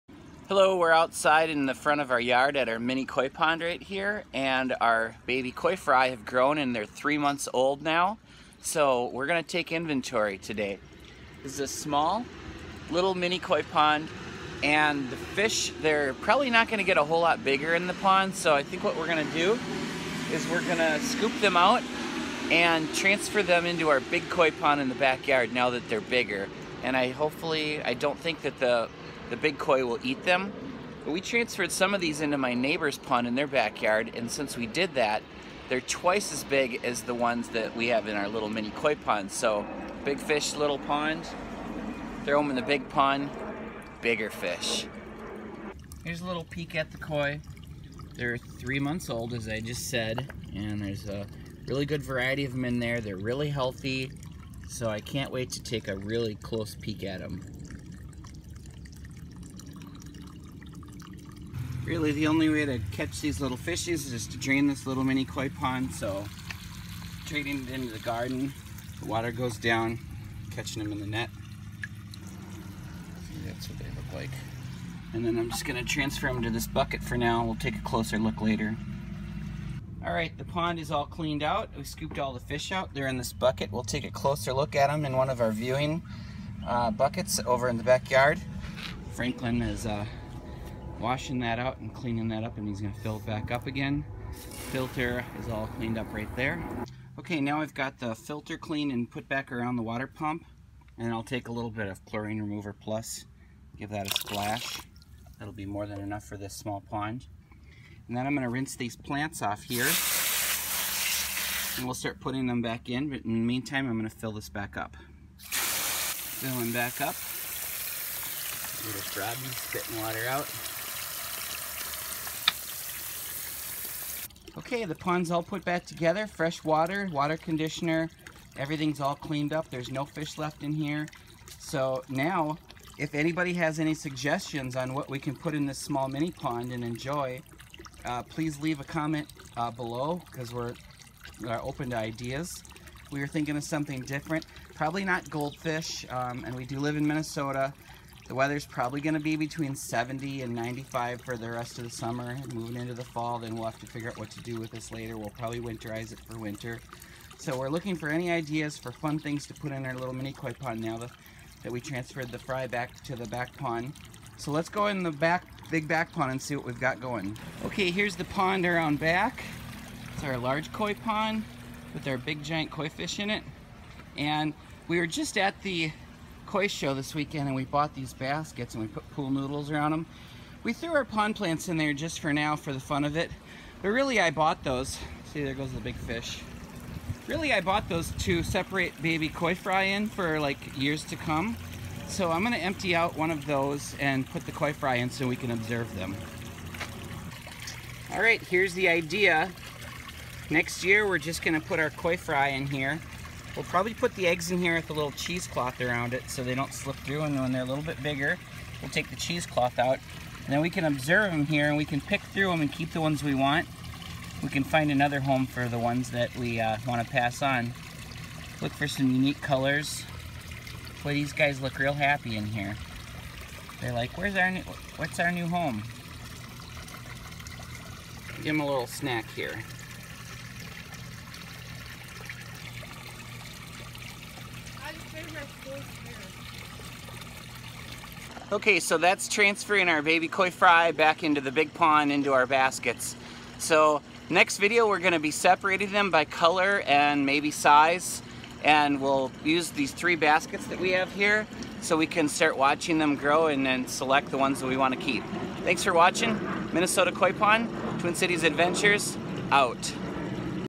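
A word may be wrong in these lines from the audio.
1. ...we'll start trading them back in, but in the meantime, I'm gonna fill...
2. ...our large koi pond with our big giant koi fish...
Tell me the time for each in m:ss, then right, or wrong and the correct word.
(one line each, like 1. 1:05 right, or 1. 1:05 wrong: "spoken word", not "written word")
1. 1:51 wrong: "putting", not "trading"
2. 2:50 right.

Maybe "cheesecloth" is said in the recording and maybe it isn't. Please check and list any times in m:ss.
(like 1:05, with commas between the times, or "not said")
3:25, 3:29.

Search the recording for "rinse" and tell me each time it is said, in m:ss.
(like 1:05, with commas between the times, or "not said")
1:48.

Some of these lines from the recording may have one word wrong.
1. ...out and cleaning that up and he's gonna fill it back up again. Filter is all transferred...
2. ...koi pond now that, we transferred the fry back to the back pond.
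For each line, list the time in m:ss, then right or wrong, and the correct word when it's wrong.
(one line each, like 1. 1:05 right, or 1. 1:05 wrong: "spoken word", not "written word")
1. 1:31 wrong: "cleaned", not "transferred"
2. 2:40 right.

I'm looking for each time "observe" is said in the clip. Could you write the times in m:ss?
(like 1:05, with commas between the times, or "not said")
3:15, 3:30.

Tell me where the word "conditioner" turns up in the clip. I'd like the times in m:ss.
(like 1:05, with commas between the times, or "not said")
2:07.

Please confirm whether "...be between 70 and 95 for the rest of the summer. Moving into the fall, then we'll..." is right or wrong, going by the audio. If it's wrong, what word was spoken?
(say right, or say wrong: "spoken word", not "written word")
right.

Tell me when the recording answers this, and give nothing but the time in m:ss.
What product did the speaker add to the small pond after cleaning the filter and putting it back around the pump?
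1:42.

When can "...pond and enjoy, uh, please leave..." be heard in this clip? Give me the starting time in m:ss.
2:16.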